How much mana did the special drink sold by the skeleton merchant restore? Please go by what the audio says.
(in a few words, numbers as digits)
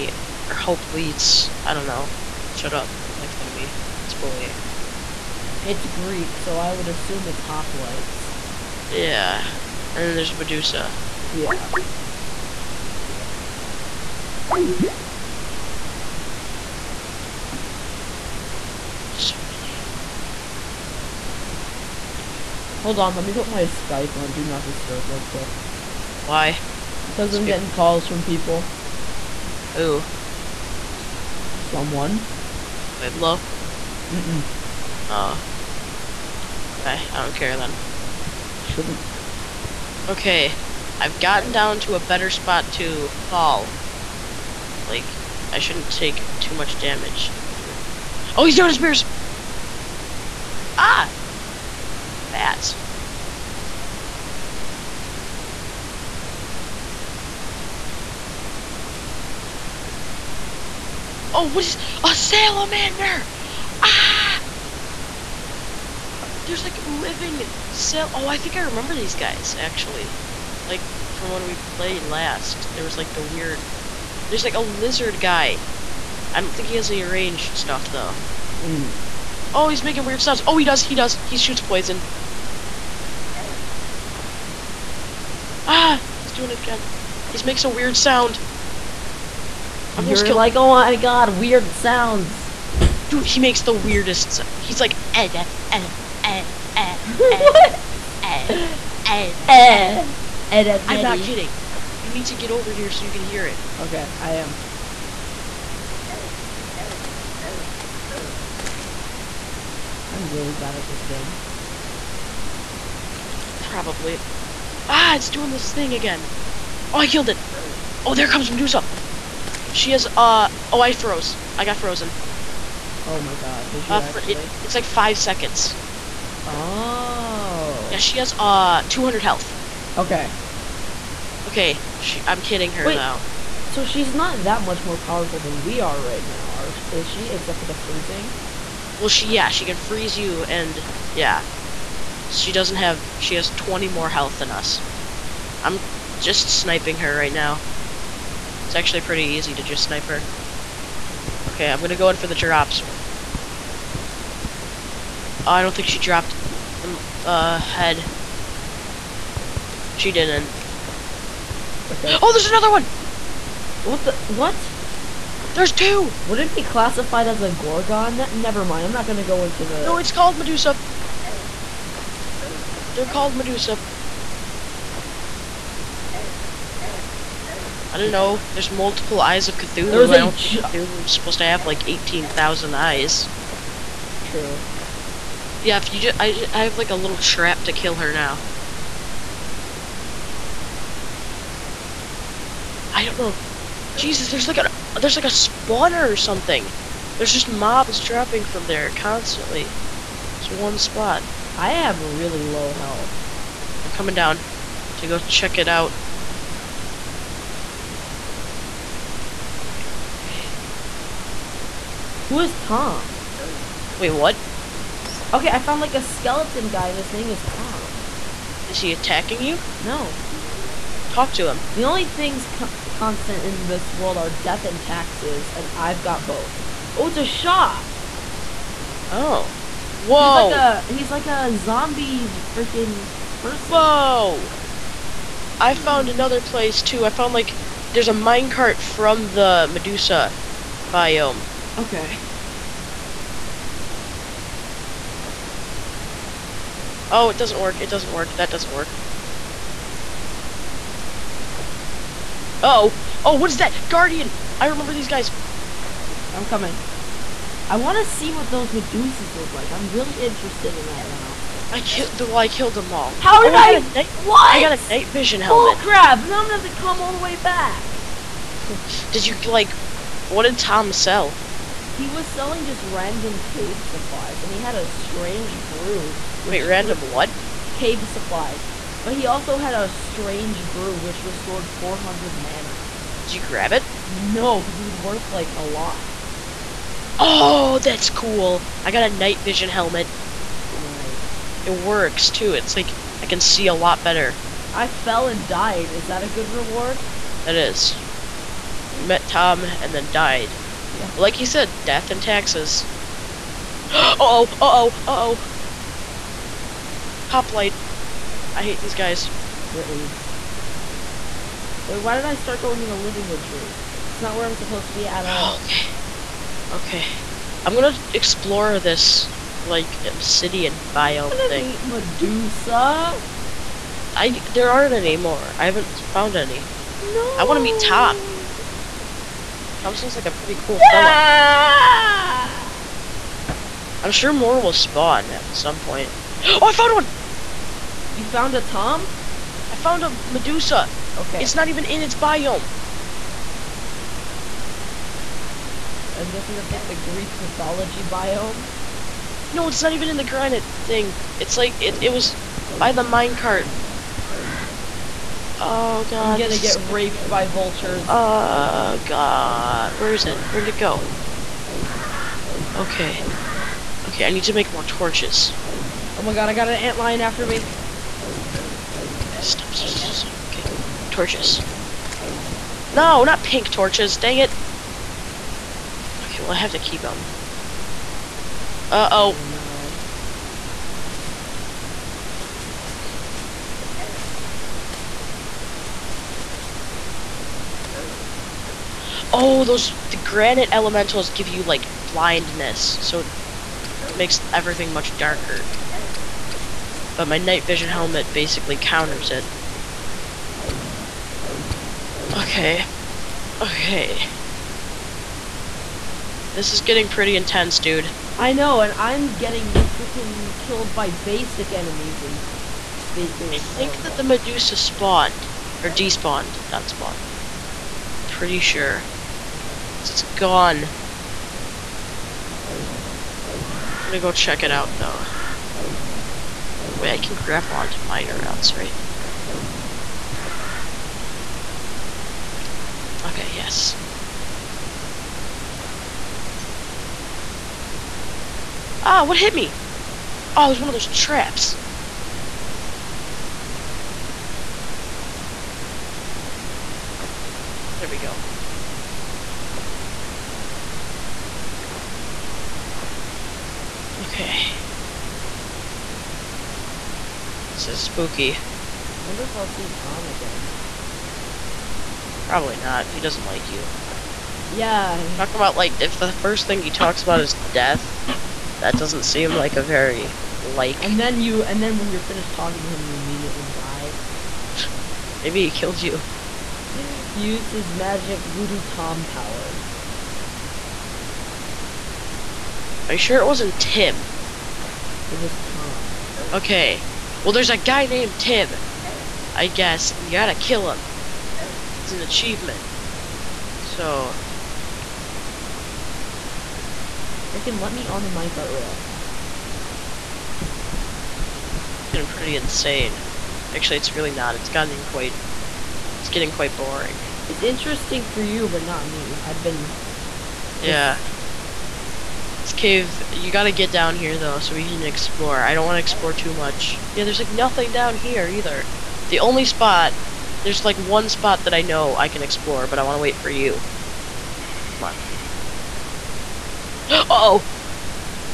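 400.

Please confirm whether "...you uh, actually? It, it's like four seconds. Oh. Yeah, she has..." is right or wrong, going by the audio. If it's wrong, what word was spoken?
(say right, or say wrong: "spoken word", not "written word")
wrong: "five", not "four".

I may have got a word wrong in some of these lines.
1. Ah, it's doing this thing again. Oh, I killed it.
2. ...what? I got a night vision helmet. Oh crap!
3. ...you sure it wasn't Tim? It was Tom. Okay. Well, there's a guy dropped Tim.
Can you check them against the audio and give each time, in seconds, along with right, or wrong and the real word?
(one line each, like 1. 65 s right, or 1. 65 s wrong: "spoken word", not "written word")
1. 114 s right
2. 264 s right
3. 483 s wrong: "named", not "dropped".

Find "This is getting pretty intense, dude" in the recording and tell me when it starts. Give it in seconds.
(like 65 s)
406 s.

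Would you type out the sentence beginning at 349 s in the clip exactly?
No, it's not even in the granite thing.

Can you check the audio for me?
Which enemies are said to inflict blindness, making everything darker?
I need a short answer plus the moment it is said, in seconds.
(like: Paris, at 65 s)
granite elementals, at 390 s.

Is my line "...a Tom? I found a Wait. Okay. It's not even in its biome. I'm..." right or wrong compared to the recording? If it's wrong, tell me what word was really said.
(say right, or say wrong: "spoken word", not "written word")
wrong: "Medusa", not "Wait".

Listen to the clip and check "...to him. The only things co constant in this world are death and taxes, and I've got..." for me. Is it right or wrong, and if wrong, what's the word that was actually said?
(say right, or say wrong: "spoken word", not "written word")
right.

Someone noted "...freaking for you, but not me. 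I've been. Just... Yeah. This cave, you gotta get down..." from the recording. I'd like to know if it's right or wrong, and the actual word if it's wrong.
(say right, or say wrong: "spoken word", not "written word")
wrong: "interesting", not "freaking".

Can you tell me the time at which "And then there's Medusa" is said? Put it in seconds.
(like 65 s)
9 s.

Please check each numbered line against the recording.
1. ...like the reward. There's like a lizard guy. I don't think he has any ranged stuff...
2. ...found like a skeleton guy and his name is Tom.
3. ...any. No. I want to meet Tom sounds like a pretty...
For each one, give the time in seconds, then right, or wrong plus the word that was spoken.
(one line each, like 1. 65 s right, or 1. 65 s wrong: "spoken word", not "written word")
1. 72 s wrong: "weird", not "reward"
2. 215 s right
3. 326 s right.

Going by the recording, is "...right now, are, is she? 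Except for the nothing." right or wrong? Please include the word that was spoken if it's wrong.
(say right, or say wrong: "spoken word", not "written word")
wrong: "freezing", not "nothing".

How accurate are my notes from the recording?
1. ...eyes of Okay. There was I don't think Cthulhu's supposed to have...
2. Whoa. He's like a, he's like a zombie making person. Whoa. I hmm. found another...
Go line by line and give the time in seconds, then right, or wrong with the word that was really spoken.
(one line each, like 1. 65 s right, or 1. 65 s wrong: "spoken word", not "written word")
1. 179 s wrong: "Cthulhu", not "Okay"
2. 229 s wrong: "freaking", not "making".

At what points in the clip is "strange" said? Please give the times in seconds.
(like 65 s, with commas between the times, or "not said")
274 s, 279 s.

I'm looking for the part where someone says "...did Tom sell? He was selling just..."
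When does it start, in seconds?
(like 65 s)
270 s.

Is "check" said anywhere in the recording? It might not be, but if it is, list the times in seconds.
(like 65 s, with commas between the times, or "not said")
205 s, 424 s.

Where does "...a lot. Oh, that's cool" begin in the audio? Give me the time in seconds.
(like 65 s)
285 s.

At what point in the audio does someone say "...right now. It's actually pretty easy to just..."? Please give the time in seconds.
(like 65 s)
147 s.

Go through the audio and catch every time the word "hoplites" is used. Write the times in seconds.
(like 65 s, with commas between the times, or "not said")
0 s, 7 s, 307 s.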